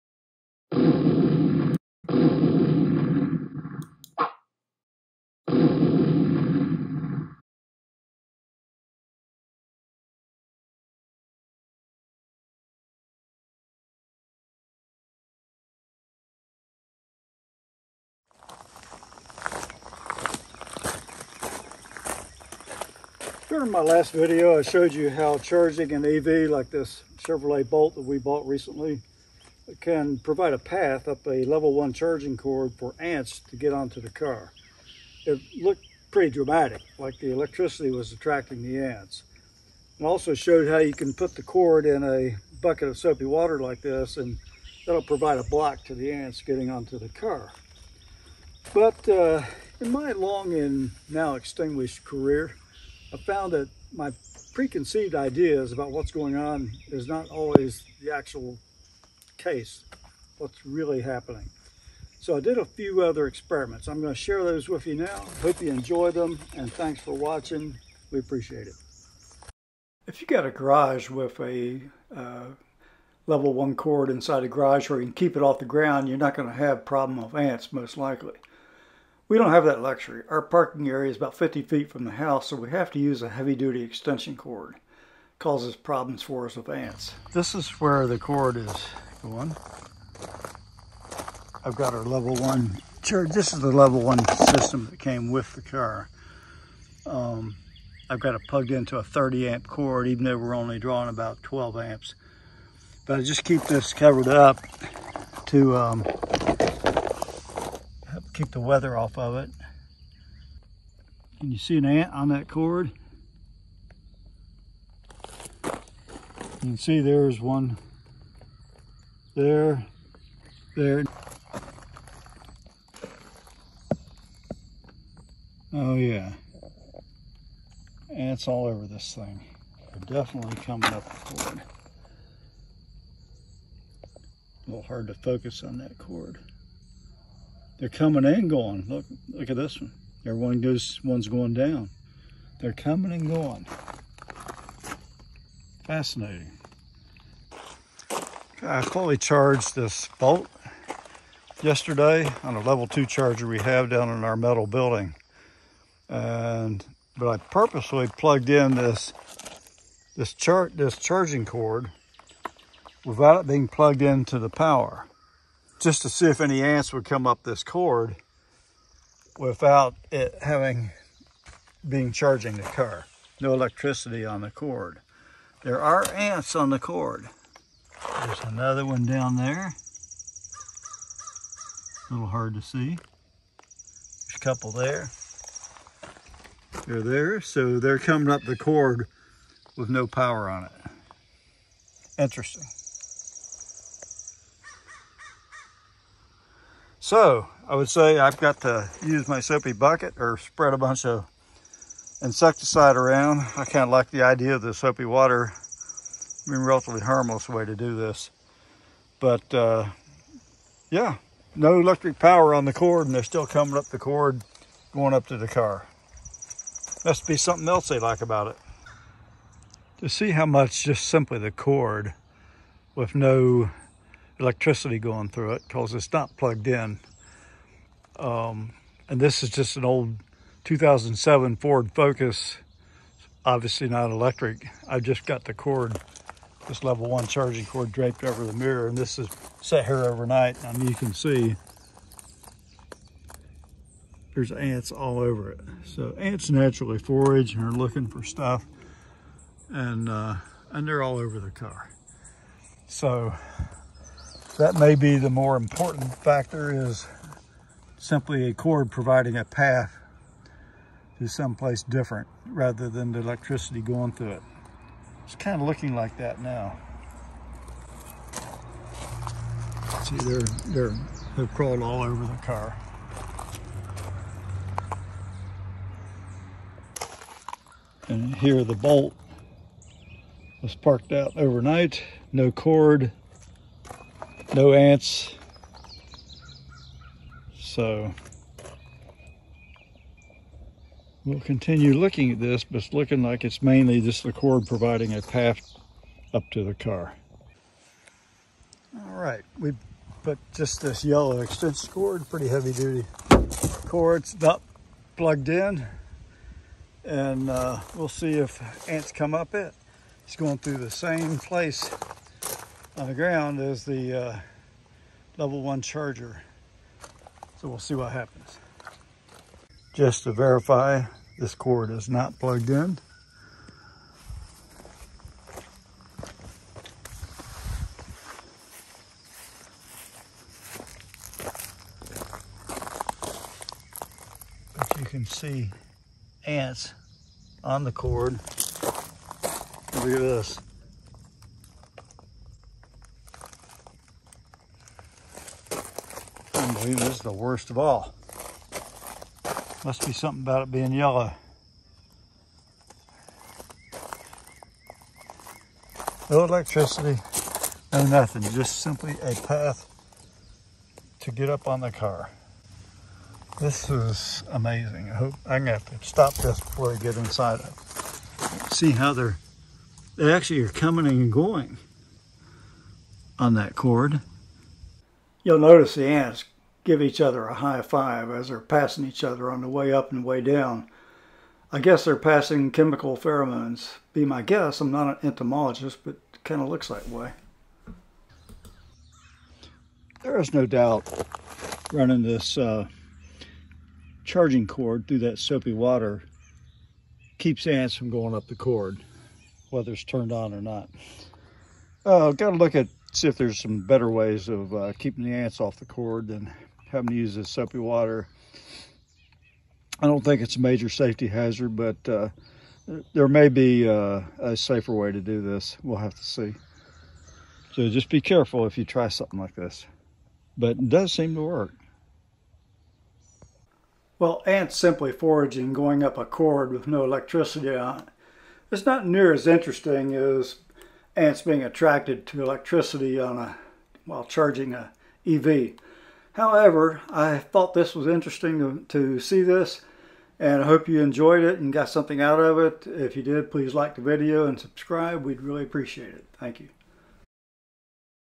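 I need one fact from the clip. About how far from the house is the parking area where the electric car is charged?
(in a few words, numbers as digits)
50 feet.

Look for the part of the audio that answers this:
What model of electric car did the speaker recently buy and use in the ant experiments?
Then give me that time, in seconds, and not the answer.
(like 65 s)
27 s.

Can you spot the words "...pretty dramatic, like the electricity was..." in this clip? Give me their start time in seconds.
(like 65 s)
36 s.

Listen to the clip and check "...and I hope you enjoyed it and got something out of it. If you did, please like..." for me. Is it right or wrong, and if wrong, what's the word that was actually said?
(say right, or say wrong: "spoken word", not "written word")
right.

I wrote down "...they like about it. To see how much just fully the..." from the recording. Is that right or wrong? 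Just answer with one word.
wrong.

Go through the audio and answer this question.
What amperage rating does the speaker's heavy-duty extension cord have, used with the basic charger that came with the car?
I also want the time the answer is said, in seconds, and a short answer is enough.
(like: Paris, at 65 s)
30 amp, at 99 s.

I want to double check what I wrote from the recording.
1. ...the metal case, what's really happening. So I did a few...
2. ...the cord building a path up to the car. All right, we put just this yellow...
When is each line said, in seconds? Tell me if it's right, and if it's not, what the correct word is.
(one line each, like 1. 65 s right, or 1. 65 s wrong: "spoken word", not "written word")
1. 58 s wrong: "actual", not "metal"
2. 294 s wrong: "providing", not "building".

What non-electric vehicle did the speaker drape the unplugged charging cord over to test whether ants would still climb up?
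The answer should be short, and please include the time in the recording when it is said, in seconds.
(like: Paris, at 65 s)
Ford Focus, at 231 s.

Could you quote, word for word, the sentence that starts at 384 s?
Be my guess, I'm not an entomologist, but it kind of looks that way.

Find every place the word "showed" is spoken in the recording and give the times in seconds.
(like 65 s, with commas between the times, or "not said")
24 s, 40 s.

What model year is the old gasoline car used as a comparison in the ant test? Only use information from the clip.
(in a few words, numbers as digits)
2007.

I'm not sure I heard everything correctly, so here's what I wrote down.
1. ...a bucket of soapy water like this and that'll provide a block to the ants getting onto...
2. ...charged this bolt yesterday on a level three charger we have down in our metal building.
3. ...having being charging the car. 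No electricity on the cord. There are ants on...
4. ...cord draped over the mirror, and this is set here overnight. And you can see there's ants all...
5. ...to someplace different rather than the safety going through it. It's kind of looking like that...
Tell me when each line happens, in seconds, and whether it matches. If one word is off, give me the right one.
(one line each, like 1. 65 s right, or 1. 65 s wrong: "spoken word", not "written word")
1. 42 s right
2. 149 s wrong: "two", not "three"
3. 170 s right
4. 237 s right
5. 261 s wrong: "electricity", not "safety".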